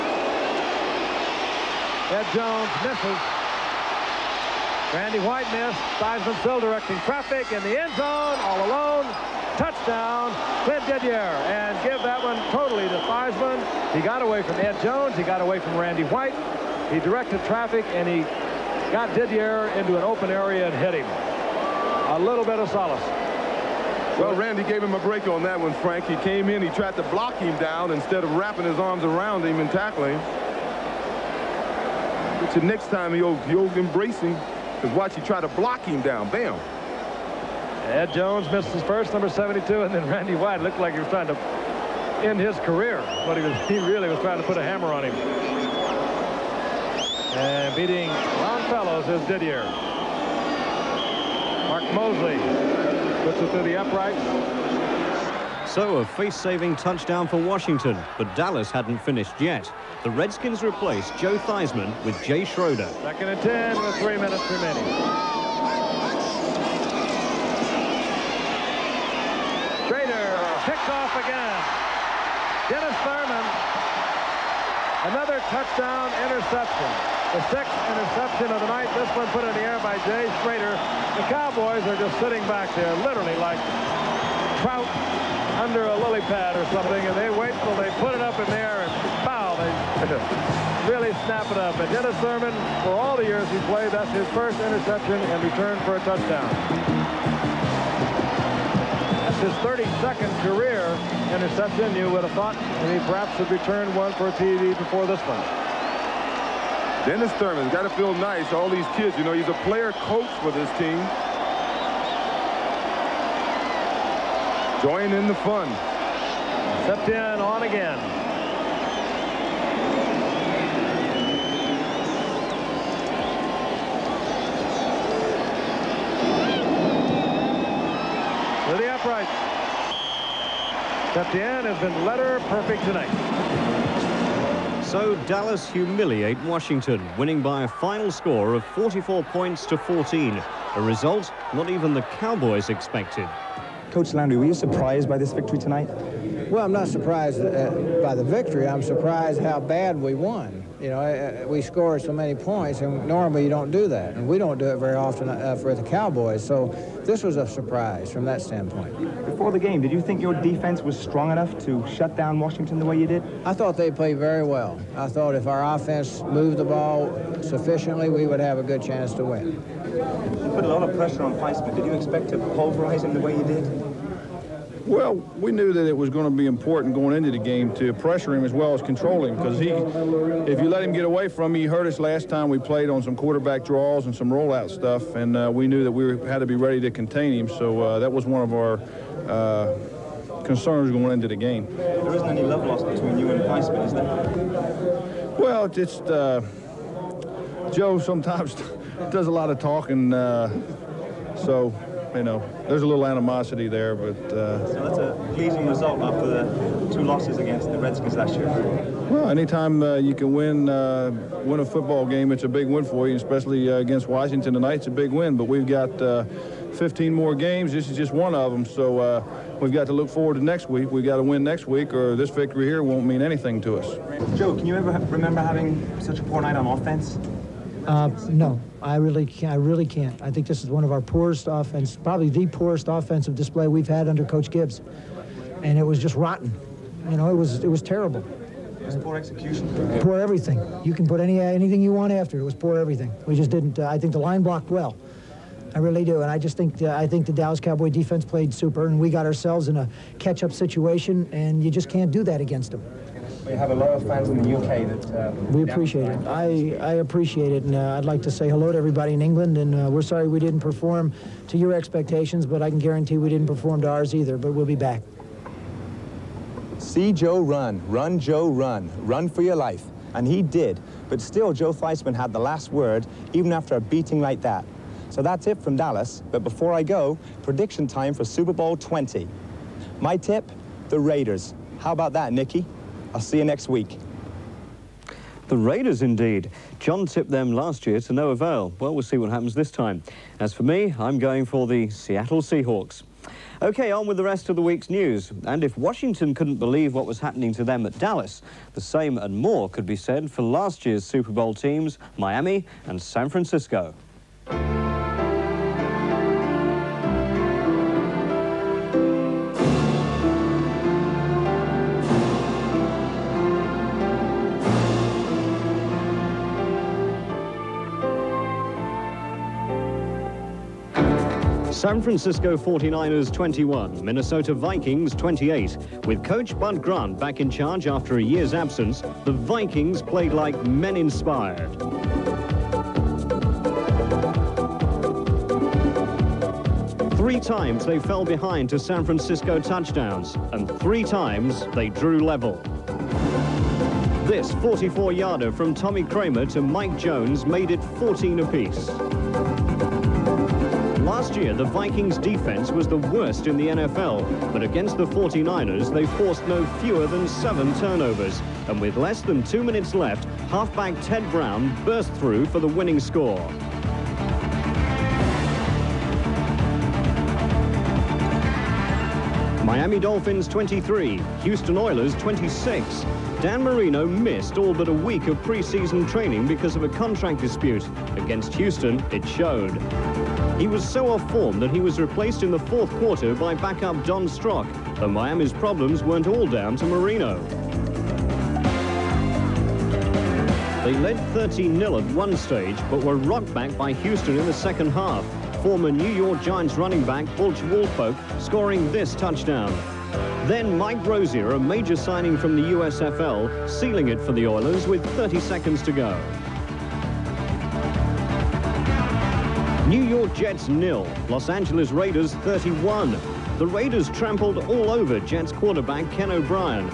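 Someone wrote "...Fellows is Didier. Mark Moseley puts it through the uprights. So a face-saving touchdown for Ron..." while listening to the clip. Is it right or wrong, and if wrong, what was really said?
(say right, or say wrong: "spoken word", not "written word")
wrong: "Washington", not "Ron".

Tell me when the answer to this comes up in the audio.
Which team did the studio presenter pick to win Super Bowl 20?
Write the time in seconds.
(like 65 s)
291 s.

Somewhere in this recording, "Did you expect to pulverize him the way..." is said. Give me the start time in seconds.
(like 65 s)
171 s.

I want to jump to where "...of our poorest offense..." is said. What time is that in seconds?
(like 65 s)
230 s.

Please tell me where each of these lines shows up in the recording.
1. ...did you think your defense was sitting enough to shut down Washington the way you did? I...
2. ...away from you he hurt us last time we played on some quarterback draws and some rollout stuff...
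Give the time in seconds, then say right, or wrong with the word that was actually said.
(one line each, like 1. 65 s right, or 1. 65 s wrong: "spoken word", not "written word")
1. 159 s wrong: "strong", not "sitting"
2. 181 s right.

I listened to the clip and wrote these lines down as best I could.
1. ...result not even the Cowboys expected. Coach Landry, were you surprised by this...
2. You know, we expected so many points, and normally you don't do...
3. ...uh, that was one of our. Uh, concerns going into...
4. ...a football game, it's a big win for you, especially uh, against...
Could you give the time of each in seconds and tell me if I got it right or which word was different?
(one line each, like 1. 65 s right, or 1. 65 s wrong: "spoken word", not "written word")
1. 140 s right
2. 150 s wrong: "scored", not "expected"
3. 187 s right
4. 211 s right.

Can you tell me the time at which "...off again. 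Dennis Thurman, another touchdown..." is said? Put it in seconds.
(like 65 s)
70 s.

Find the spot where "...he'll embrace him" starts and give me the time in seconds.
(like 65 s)
33 s.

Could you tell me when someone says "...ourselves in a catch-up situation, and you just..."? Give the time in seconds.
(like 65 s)
249 s.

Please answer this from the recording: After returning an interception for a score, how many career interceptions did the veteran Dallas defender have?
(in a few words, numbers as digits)
32.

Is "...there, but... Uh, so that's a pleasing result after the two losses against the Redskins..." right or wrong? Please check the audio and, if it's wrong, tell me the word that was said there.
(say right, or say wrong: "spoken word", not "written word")
right.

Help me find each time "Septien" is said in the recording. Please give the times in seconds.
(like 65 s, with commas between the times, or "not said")
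116 s, 131 s.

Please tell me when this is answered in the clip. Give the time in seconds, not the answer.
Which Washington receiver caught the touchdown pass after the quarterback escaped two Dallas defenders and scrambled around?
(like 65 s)
10 s.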